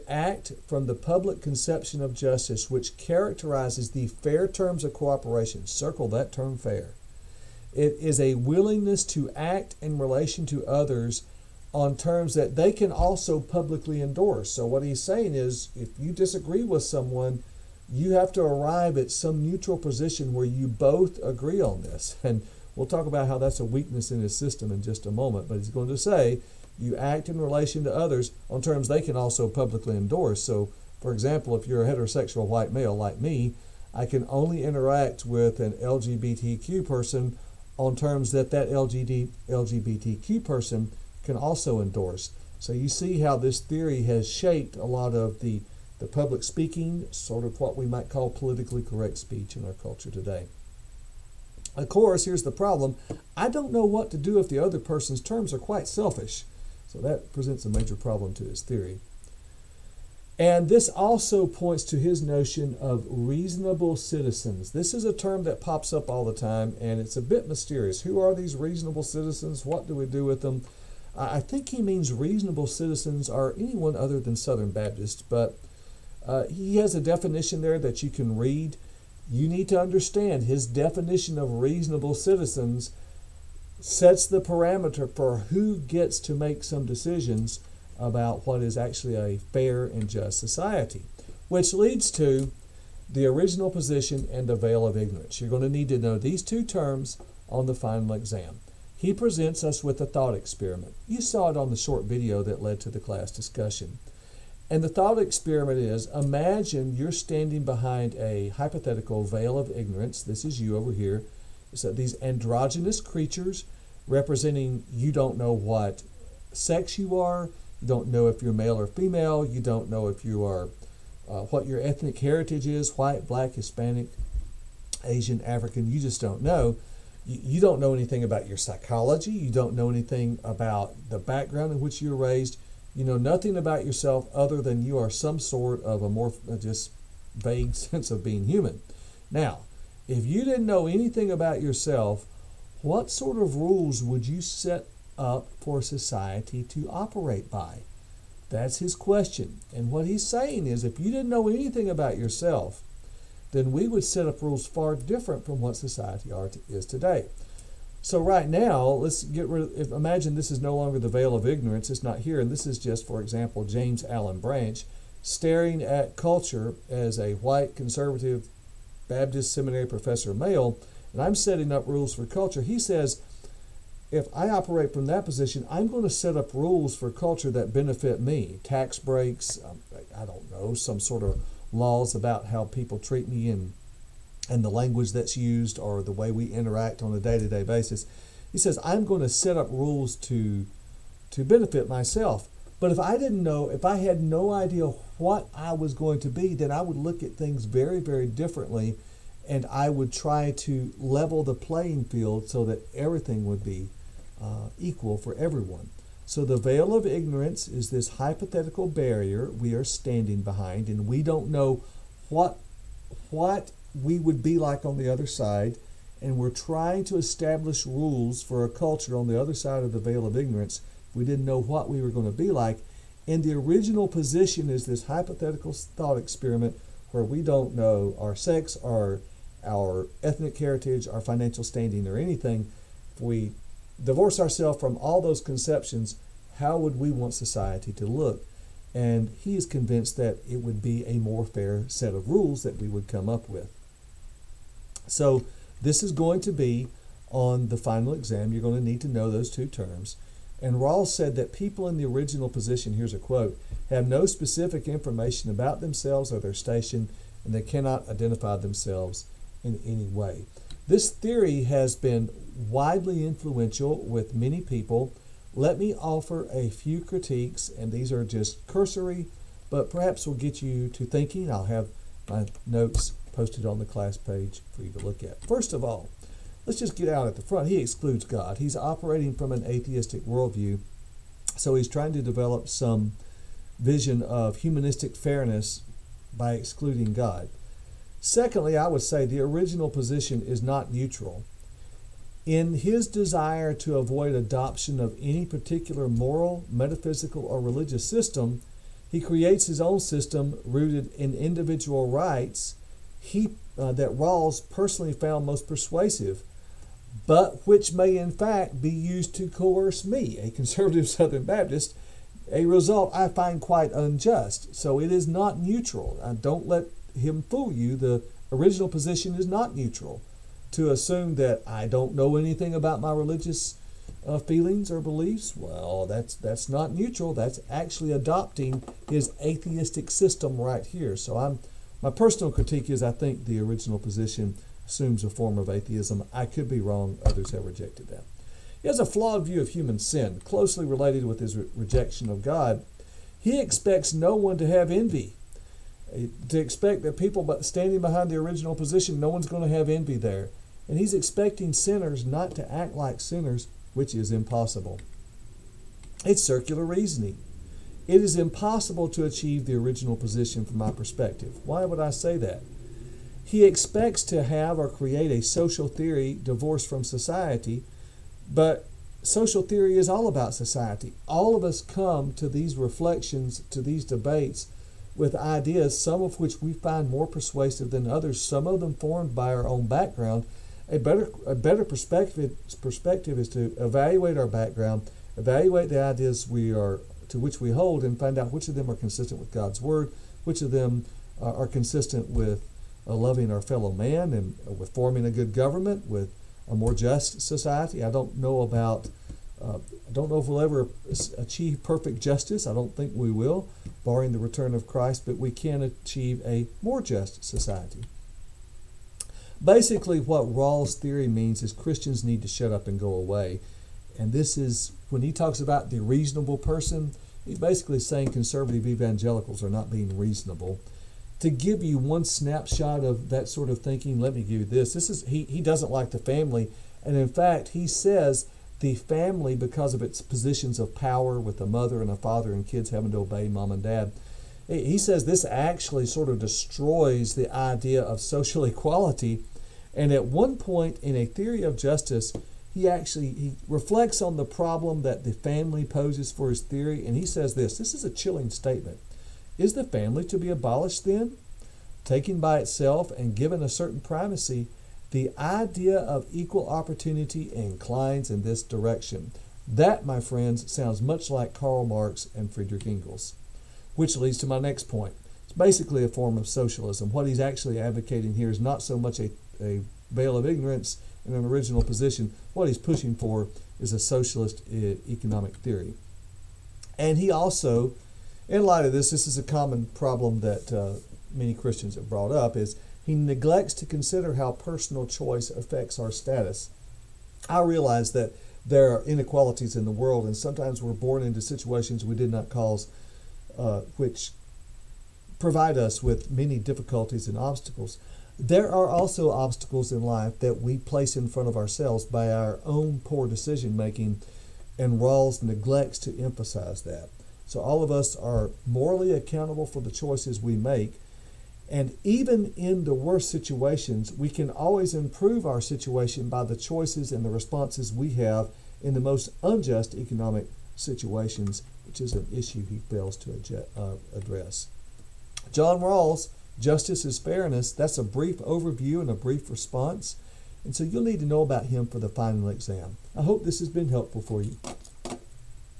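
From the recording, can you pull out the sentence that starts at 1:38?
He presents us with a thought experiment.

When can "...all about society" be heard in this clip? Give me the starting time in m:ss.
6:10.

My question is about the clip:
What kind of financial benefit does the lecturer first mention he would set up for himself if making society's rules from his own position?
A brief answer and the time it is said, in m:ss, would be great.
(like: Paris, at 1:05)
Tax breaks, at 2:58.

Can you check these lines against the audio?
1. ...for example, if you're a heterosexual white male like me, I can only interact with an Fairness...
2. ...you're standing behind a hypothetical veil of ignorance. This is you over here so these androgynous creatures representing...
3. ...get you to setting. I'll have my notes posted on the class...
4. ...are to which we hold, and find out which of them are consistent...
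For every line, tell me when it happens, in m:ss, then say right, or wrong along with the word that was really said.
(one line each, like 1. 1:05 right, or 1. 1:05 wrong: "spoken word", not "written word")
1. 0:31 wrong: "LGBTQ", not "Fairness"
2. 1:46 right
3. 4:30 wrong: "thinking", not "setting"
4. 6:26 right.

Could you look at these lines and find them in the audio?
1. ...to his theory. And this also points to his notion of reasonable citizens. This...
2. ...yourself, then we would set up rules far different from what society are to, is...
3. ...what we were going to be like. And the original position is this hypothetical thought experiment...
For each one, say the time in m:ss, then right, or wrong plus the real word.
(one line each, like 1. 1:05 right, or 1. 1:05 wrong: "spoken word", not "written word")
1. 0:58 right
2. 2:32 right
3. 3:41 right.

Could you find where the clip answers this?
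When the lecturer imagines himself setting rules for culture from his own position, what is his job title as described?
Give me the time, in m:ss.
2:49.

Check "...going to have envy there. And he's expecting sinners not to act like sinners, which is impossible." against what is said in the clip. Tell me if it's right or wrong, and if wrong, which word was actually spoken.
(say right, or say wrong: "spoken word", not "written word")
right.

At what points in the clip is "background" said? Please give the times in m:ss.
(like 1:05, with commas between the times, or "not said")
2:11, 6:19, 6:24.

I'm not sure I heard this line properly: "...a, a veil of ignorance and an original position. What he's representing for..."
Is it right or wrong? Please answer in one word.
wrong.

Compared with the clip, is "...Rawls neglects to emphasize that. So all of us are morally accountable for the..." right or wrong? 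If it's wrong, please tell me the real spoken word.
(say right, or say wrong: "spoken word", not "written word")
right.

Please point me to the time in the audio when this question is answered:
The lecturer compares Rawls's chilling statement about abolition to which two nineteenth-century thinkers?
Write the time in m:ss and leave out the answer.
7:41.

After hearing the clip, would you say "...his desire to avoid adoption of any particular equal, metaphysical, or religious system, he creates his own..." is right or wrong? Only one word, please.
wrong.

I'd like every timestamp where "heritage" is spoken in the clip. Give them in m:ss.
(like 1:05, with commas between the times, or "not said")
2:02, 3:50.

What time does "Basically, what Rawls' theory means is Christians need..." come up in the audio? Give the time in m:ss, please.
6:49.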